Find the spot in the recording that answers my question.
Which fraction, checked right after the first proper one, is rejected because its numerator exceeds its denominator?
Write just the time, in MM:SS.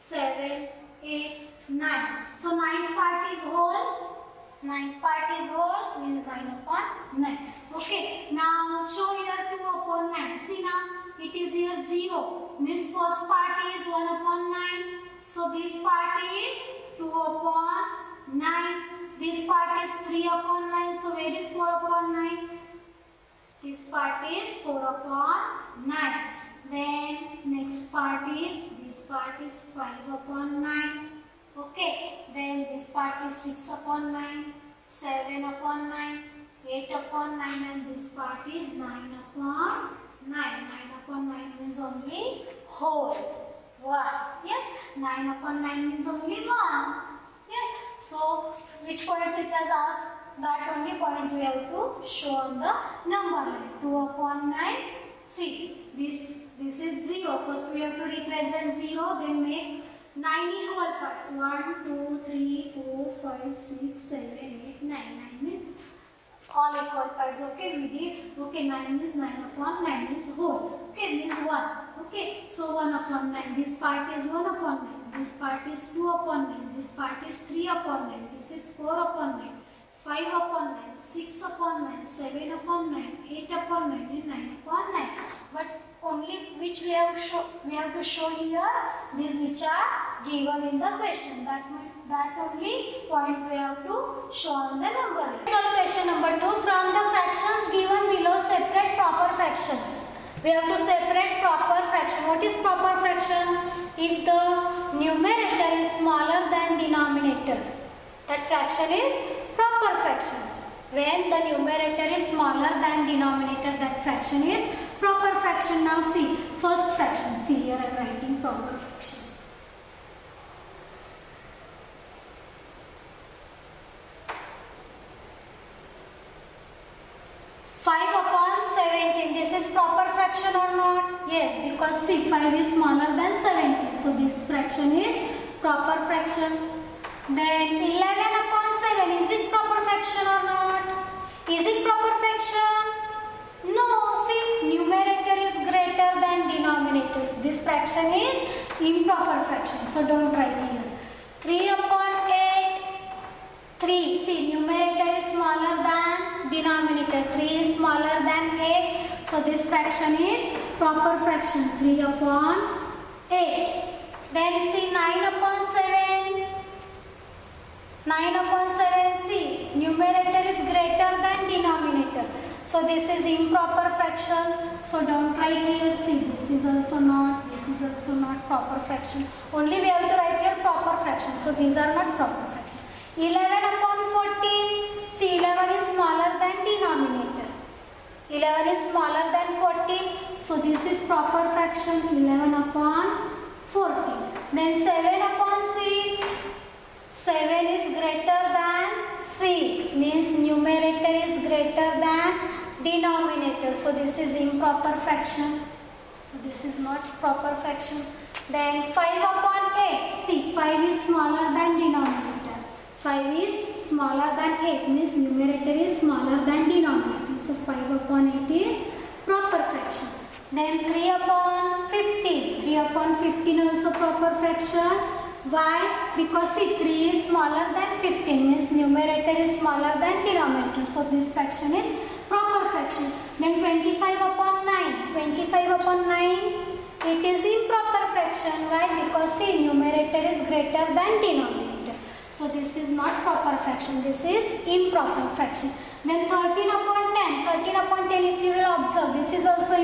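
02:17.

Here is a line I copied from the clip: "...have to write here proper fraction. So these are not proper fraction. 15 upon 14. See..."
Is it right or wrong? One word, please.
wrong.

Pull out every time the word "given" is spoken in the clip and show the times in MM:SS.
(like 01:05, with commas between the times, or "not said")
01:30, 01:37.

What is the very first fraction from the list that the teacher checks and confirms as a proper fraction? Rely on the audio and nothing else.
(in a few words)
5/17.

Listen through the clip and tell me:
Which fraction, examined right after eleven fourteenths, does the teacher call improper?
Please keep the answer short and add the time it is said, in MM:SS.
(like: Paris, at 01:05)
7/6, at 03:14.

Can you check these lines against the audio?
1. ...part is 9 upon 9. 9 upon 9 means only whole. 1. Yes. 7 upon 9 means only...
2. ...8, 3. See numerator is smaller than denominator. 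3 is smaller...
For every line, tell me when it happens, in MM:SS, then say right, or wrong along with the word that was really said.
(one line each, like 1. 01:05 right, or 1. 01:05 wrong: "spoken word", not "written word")
1. 00:38 wrong: "9", not "7"
2. 02:32 right.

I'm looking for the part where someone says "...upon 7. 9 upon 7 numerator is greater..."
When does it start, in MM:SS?
02:45.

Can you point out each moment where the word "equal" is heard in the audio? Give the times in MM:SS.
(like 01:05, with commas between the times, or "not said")
01:00, 01:06.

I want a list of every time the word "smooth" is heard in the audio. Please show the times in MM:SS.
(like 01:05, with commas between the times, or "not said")
not said.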